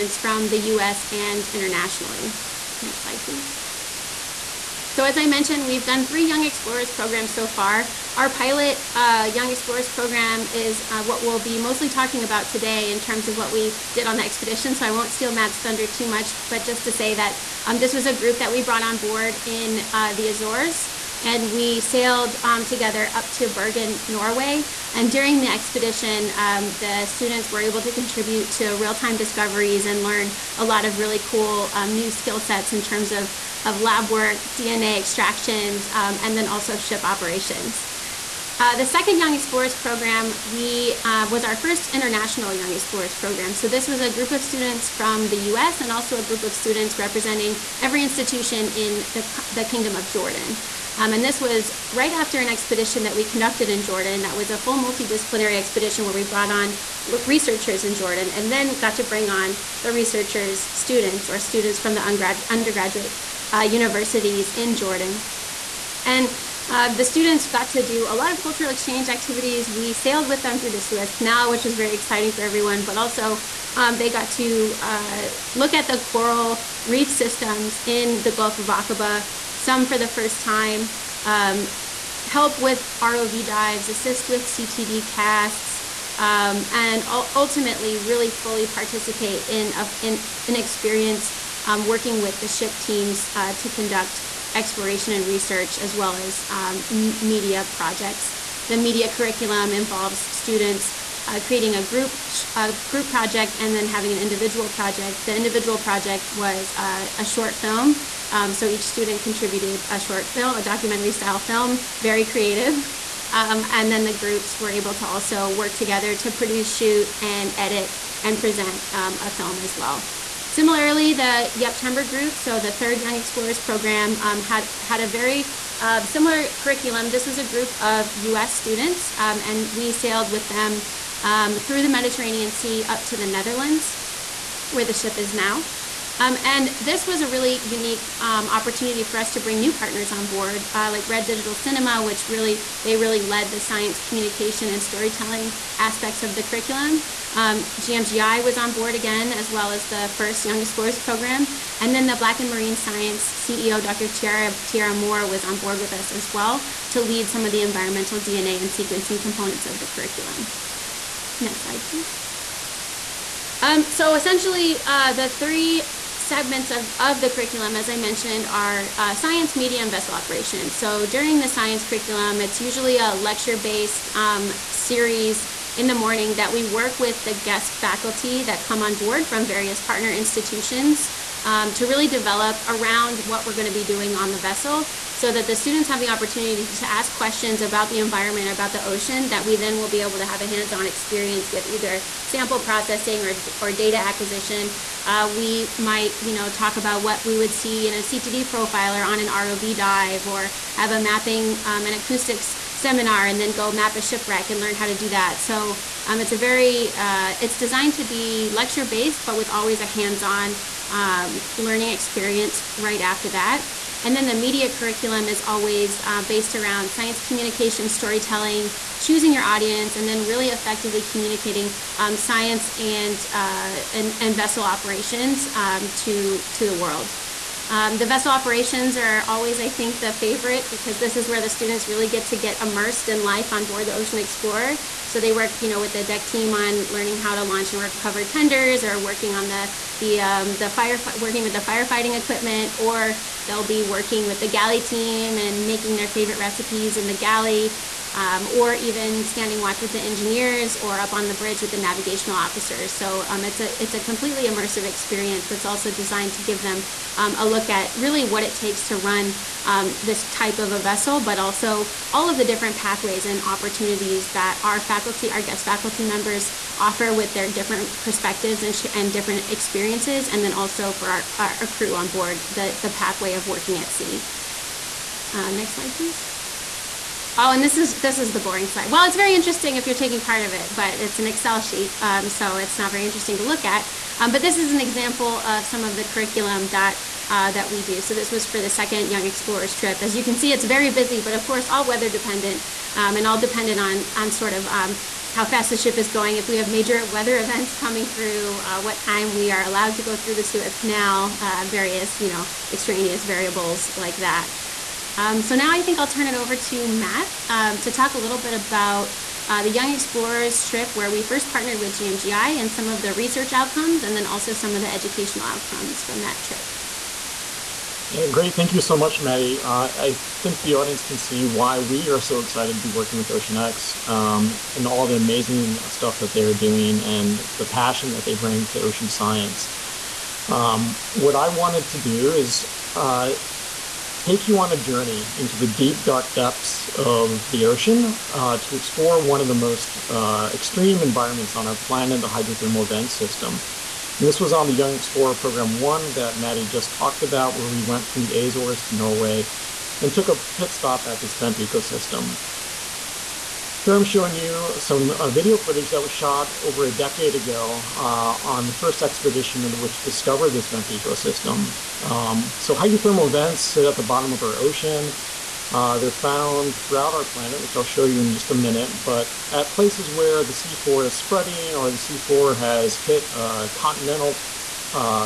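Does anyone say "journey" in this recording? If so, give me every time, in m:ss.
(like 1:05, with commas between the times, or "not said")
5:34.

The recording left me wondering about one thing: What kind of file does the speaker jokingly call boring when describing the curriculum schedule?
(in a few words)
Excel sheet.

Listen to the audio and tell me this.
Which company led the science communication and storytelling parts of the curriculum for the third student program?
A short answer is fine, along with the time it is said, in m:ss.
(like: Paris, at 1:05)
Red Digital Cinema, at 2:21.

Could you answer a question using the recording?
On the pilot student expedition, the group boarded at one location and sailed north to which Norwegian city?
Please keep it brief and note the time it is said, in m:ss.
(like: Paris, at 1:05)
Bergen, at 0:23.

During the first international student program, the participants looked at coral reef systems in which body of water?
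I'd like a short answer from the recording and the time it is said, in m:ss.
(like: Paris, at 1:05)
Gulf of Aqaba, at 1:18.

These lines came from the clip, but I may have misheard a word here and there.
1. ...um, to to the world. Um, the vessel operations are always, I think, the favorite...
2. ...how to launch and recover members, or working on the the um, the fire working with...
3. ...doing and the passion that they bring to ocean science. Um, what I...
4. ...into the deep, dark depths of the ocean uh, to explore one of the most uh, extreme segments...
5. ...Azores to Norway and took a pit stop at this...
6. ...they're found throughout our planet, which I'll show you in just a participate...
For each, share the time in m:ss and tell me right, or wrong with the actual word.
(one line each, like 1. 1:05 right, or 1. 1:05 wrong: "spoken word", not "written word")
1. 3:45 right
2. 3:57 wrong: "tenders", not "members"
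3. 5:26 right
4. 5:35 wrong: "environments", not "segments"
5. 5:48 right
6. 6:05 wrong: "minute", not "participate".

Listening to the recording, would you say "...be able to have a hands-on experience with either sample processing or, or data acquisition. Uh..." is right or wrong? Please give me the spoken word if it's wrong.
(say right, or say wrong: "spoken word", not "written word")
right.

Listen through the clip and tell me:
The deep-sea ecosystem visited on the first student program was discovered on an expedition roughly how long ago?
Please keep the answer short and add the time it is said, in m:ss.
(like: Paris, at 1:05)
over a decade ago, at 5:56.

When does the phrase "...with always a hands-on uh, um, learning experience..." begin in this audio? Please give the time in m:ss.
3:29.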